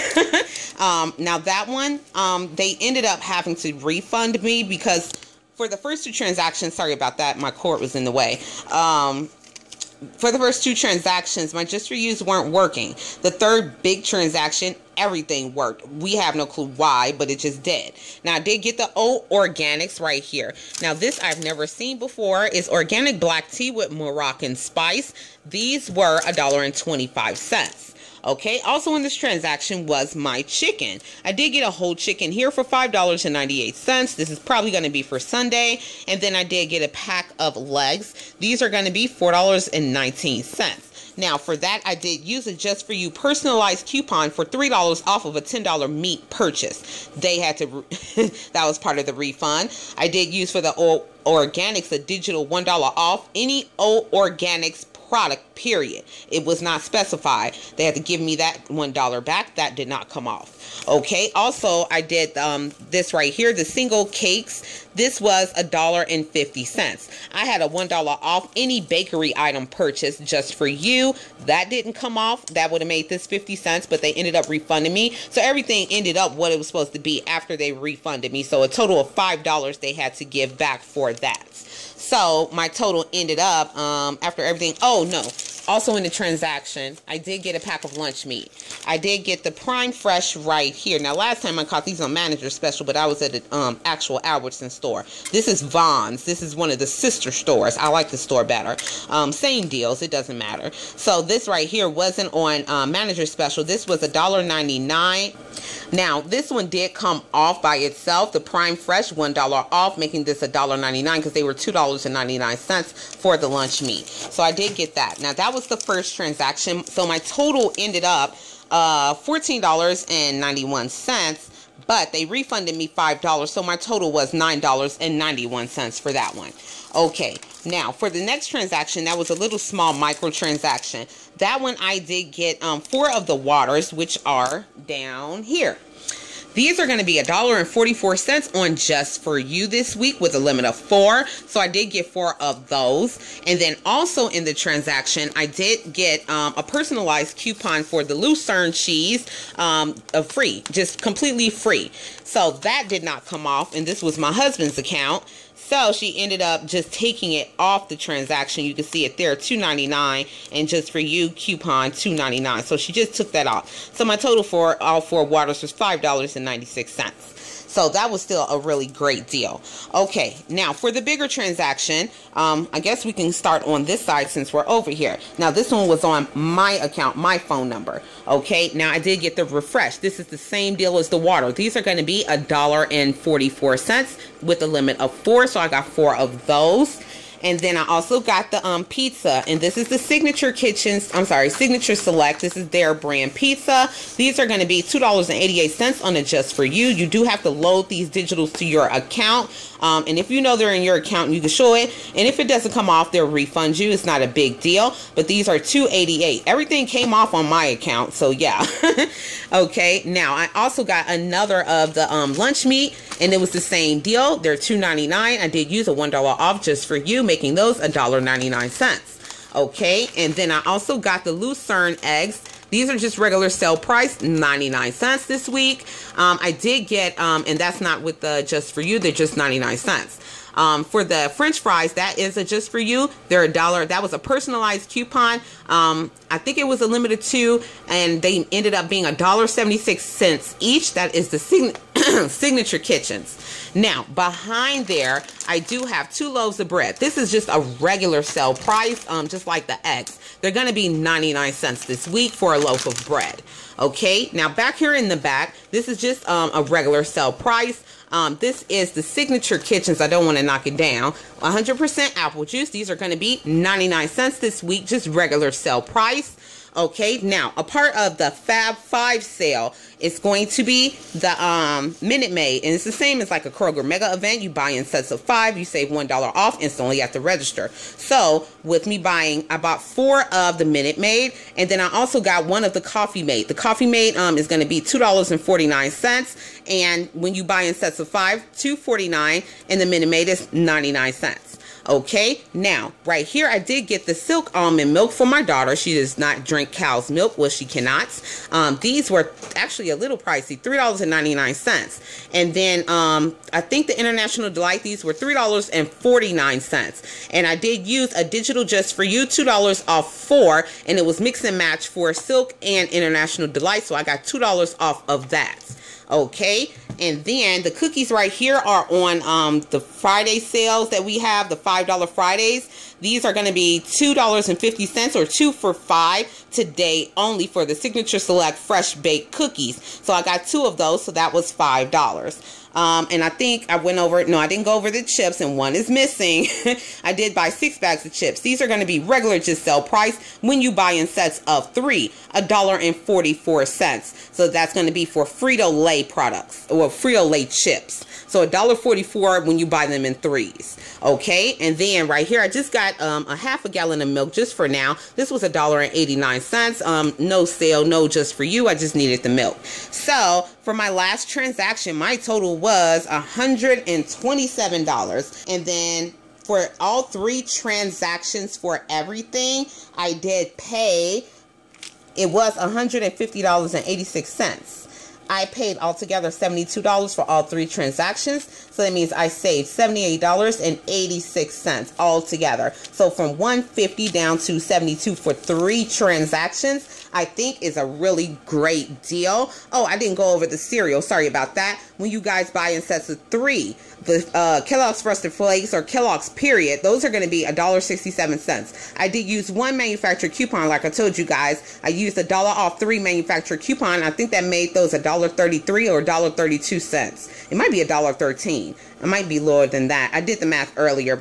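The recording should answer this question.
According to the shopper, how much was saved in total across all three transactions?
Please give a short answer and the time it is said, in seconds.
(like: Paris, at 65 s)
$78.86, at 379 s.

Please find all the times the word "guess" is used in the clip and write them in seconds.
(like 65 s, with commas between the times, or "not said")
172 s.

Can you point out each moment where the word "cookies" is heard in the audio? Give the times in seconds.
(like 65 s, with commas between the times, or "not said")
317 s, 329 s.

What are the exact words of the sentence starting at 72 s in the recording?
That would have made this 50 cents, but they ended up refunding me.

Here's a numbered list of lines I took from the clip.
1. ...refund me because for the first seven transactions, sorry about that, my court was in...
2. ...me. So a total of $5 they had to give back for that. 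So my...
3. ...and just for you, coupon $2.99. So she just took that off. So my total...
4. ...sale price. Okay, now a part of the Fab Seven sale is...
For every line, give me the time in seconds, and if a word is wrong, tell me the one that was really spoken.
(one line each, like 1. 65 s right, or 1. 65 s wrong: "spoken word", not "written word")
1. 3 s wrong: "two", not "seven"
2. 78 s right
3. 160 s right
4. 265 s wrong: "Five", not "Seven".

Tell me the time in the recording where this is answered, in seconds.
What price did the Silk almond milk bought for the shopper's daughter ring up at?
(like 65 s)
300 s.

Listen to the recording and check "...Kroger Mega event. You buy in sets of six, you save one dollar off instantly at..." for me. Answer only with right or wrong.
wrong.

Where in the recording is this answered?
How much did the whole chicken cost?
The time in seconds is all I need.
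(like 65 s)
32 s.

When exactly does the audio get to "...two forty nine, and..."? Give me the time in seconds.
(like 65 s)
288 s.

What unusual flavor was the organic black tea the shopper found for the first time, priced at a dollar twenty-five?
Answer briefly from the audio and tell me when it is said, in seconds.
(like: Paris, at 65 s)
Moroccan spice, at 23 s.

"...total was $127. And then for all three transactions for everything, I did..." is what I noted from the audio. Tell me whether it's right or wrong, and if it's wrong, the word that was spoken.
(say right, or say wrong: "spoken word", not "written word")
right.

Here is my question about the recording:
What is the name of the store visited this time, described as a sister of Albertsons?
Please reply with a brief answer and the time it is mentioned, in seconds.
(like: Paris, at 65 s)
Vons, at 95 s.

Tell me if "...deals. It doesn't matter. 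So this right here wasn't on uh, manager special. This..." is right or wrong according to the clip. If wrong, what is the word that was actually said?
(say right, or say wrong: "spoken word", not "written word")
right.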